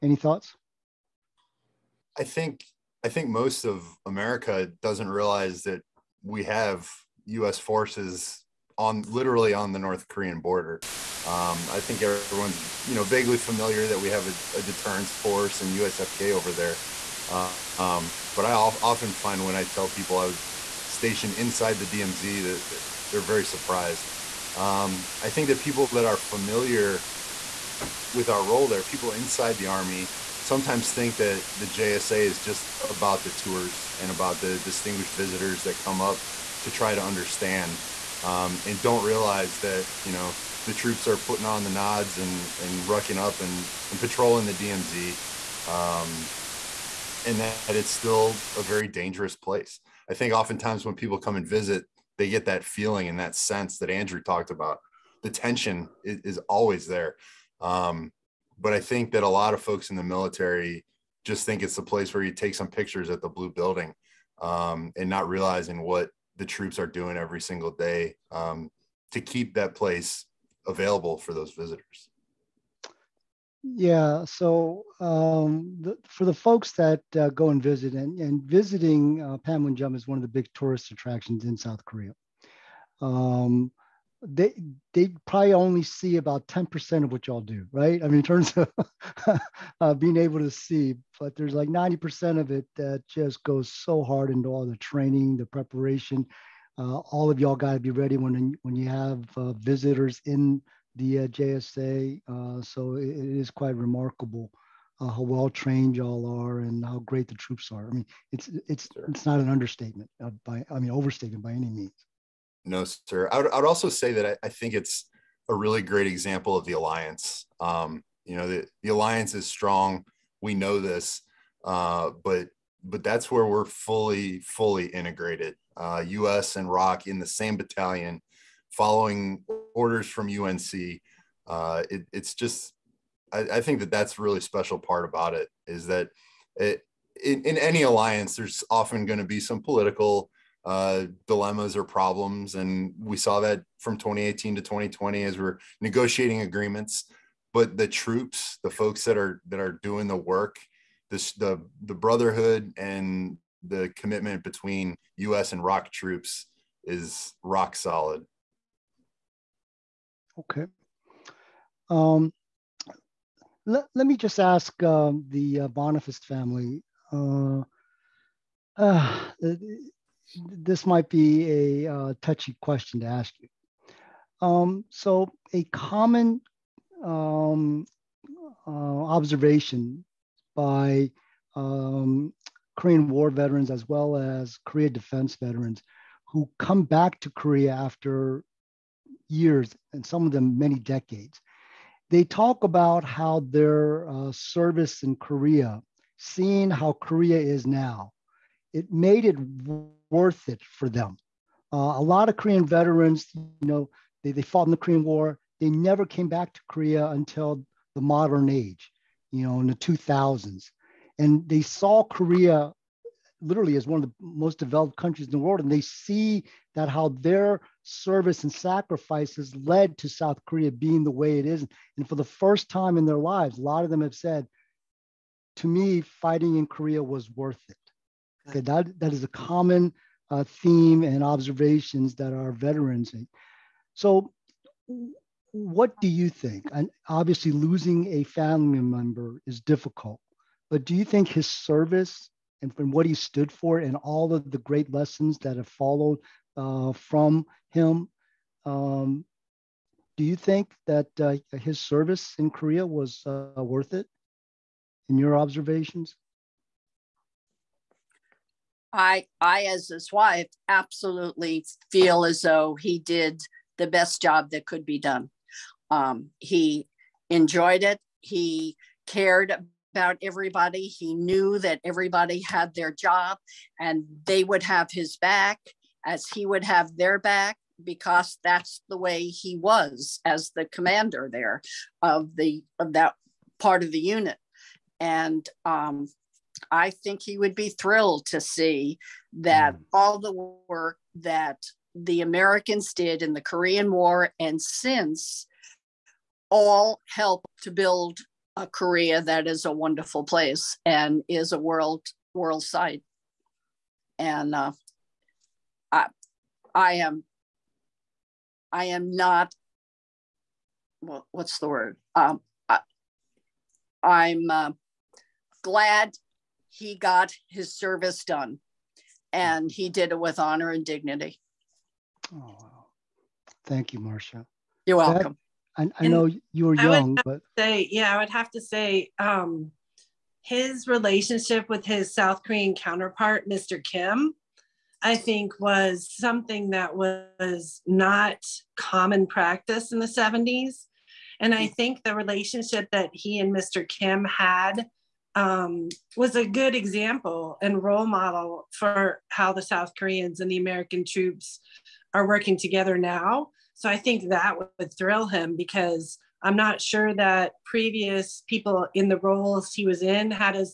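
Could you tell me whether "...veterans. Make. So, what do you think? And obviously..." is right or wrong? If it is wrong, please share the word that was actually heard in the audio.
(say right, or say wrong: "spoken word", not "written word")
right.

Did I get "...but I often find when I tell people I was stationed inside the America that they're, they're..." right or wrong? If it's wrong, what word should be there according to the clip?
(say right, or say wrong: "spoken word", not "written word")
wrong: "DMZ", not "America".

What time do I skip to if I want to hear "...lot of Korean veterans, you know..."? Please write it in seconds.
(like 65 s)
202 s.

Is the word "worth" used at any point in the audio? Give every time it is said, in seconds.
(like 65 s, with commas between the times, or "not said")
200 s, 227 s, 253 s.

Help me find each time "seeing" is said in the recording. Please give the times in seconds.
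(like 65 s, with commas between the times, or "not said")
196 s.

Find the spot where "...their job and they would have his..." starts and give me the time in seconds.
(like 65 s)
272 s.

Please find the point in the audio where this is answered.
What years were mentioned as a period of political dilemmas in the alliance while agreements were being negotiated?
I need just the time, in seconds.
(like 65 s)
143 s.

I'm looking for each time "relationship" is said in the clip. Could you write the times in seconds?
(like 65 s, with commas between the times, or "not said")
330 s, 342 s.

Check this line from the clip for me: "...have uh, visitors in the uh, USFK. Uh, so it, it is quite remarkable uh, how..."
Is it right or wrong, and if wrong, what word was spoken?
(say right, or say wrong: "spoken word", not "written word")
wrong: "JSA", not "USFK".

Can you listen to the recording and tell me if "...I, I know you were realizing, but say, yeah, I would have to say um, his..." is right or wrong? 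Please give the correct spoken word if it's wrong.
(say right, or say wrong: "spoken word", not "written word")
wrong: "young", not "realizing".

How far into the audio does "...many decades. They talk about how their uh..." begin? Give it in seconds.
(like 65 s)
190 s.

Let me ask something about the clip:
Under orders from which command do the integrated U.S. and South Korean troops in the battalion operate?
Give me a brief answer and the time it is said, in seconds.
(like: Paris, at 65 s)
UNC, at 130 s.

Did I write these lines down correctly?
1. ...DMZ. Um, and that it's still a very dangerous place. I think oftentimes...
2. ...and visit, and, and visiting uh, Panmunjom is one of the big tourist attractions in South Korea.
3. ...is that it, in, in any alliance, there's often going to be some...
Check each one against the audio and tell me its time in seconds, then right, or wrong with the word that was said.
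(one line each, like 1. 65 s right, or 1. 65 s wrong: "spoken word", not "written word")
1. 44 s right
2. 77 s right
3. 135 s right.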